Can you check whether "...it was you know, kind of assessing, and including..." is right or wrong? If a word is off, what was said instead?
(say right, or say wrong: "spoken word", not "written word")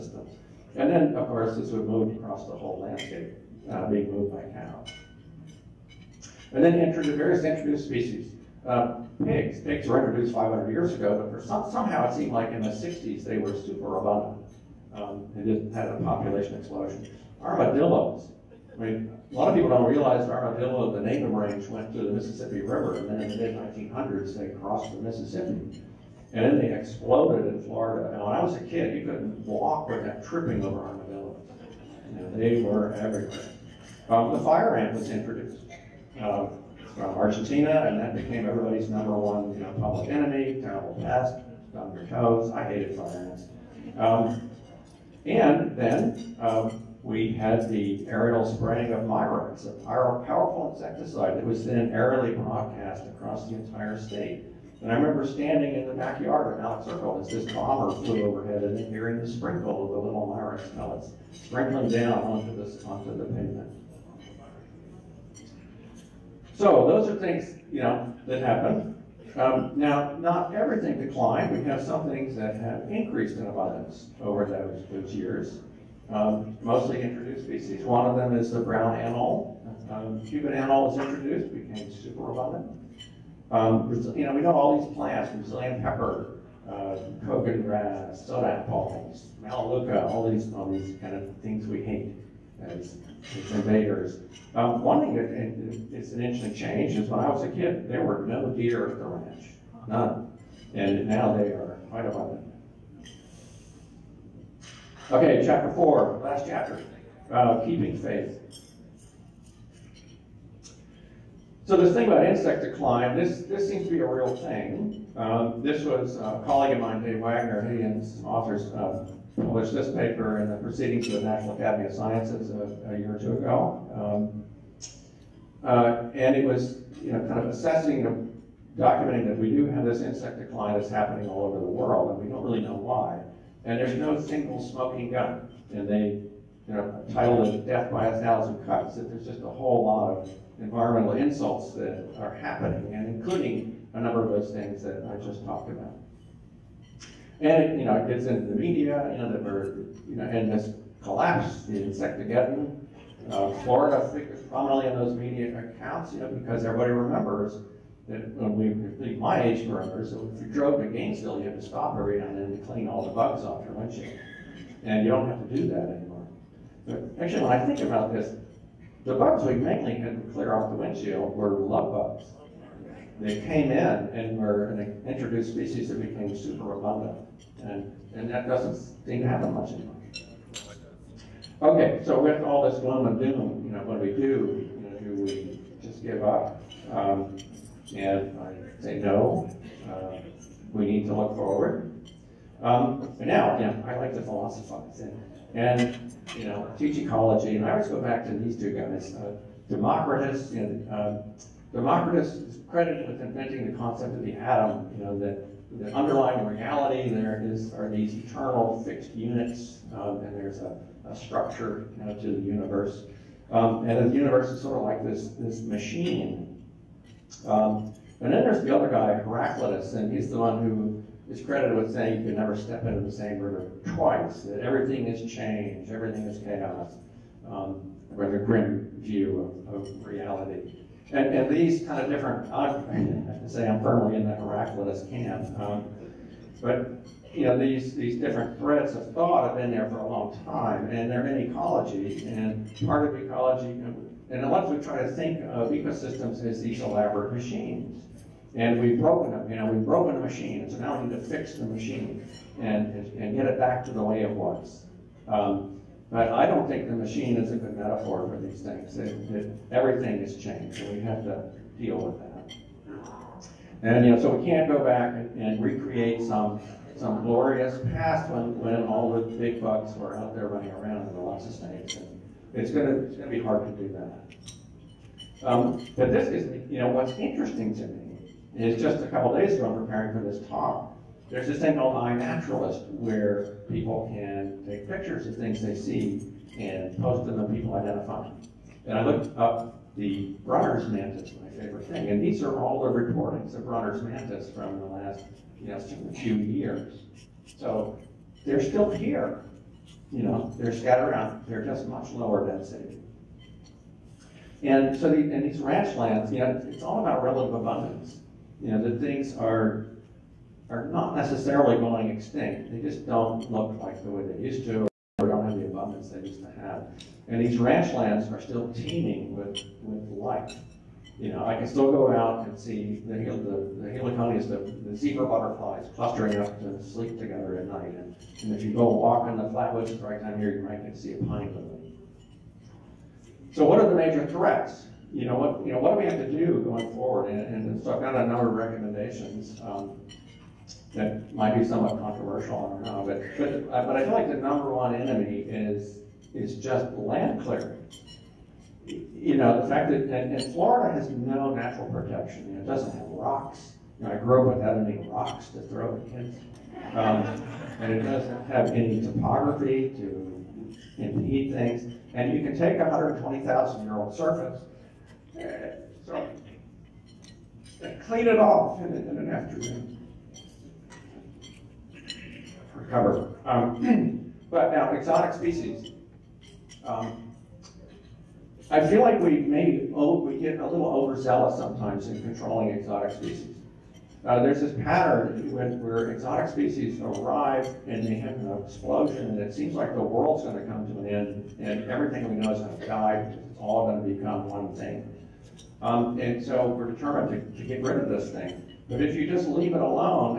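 wrong: "documenting", not "including".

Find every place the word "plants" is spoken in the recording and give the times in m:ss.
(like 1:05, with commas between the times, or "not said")
1:24.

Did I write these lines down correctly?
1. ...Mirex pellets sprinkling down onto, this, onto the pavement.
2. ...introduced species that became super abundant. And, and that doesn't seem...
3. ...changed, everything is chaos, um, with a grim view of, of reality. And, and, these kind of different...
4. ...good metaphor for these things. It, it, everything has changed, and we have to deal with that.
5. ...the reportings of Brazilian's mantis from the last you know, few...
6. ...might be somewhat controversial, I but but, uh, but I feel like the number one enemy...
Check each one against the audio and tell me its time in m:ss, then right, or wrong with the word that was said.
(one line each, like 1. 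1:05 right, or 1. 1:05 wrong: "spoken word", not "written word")
1. 1:00 right
2. 2:55 right
3. 3:45 right
4. 4:17 right
5. 4:52 wrong: "Brunner", not "Brazilian"
6. 5:41 right.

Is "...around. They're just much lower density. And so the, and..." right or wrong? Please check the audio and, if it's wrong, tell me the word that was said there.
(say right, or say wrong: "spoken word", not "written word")
right.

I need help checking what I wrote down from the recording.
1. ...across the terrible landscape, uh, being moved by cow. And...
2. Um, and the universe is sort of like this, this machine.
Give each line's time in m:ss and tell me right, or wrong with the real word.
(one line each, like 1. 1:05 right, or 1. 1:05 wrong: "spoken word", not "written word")
1. 0:02 wrong: "whole", not "terrible"
2. 3:33 right.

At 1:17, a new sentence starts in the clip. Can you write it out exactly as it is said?
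One of them is the brown anole.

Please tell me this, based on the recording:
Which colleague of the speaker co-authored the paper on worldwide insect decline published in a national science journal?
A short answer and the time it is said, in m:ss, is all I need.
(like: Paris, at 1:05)
Dave Wagner, at 1:57.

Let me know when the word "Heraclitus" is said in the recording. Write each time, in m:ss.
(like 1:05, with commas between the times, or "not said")
3:39, 3:54.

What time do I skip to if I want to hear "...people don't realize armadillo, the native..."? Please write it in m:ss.
0:19.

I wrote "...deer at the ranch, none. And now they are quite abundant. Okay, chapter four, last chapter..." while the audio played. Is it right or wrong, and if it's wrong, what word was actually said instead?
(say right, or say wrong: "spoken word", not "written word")
right.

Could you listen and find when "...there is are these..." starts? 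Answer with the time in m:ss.
3:27.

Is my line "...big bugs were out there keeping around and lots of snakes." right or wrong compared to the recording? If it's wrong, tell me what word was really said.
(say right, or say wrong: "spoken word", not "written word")
wrong: "running", not "keeping".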